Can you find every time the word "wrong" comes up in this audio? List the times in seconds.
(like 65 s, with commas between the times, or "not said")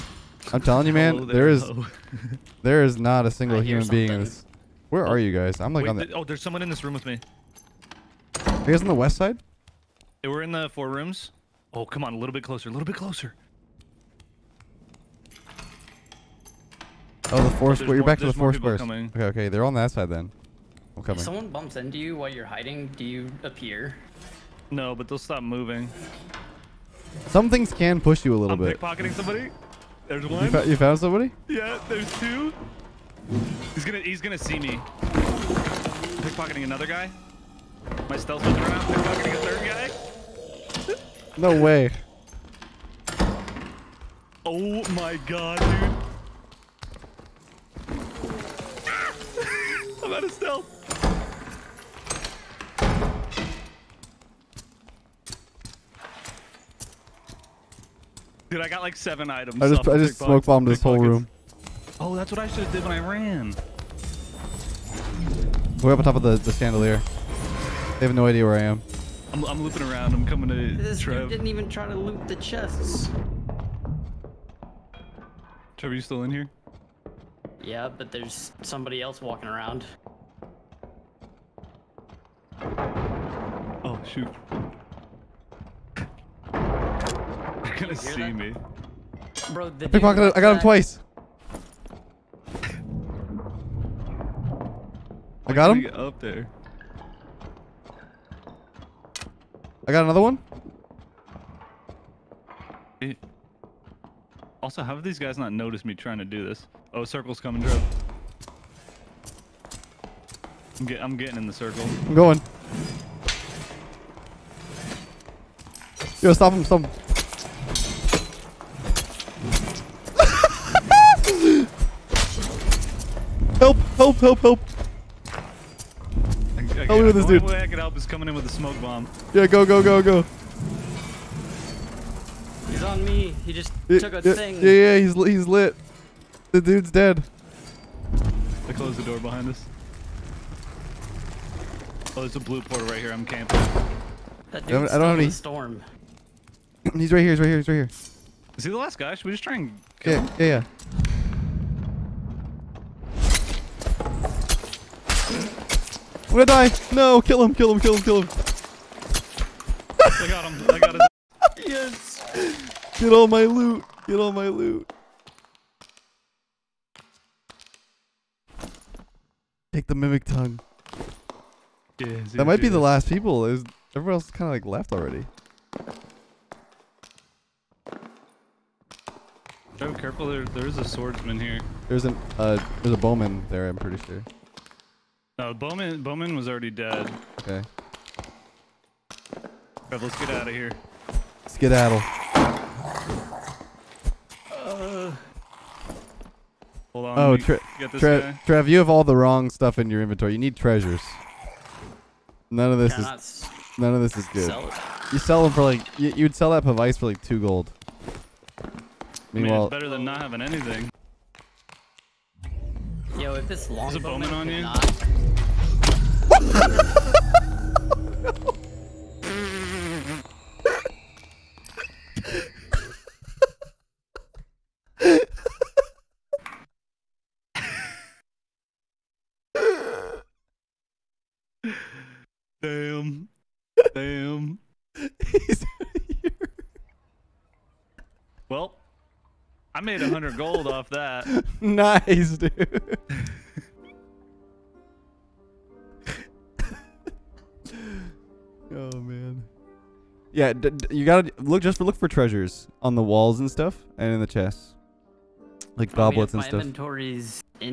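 199 s.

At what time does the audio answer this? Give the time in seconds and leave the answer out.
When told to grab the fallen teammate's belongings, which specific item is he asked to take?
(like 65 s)
169 s.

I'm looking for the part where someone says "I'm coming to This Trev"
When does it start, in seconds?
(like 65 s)
70 s.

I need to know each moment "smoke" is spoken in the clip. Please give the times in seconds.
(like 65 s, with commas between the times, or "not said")
60 s, 128 s.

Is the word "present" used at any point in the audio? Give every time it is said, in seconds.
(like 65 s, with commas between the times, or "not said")
not said.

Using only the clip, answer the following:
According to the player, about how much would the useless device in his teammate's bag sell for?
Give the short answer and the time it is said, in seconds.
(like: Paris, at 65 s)
2 gold, at 207 s.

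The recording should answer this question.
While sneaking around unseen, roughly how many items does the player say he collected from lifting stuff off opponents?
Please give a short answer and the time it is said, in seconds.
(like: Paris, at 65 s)
7, at 58 s.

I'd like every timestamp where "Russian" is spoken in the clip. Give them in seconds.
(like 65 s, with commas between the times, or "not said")
not said.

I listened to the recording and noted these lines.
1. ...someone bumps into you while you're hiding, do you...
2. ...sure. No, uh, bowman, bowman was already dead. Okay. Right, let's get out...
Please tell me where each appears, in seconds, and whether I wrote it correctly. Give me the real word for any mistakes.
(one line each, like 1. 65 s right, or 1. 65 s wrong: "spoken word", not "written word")
1. 21 s right
2. 184 s right.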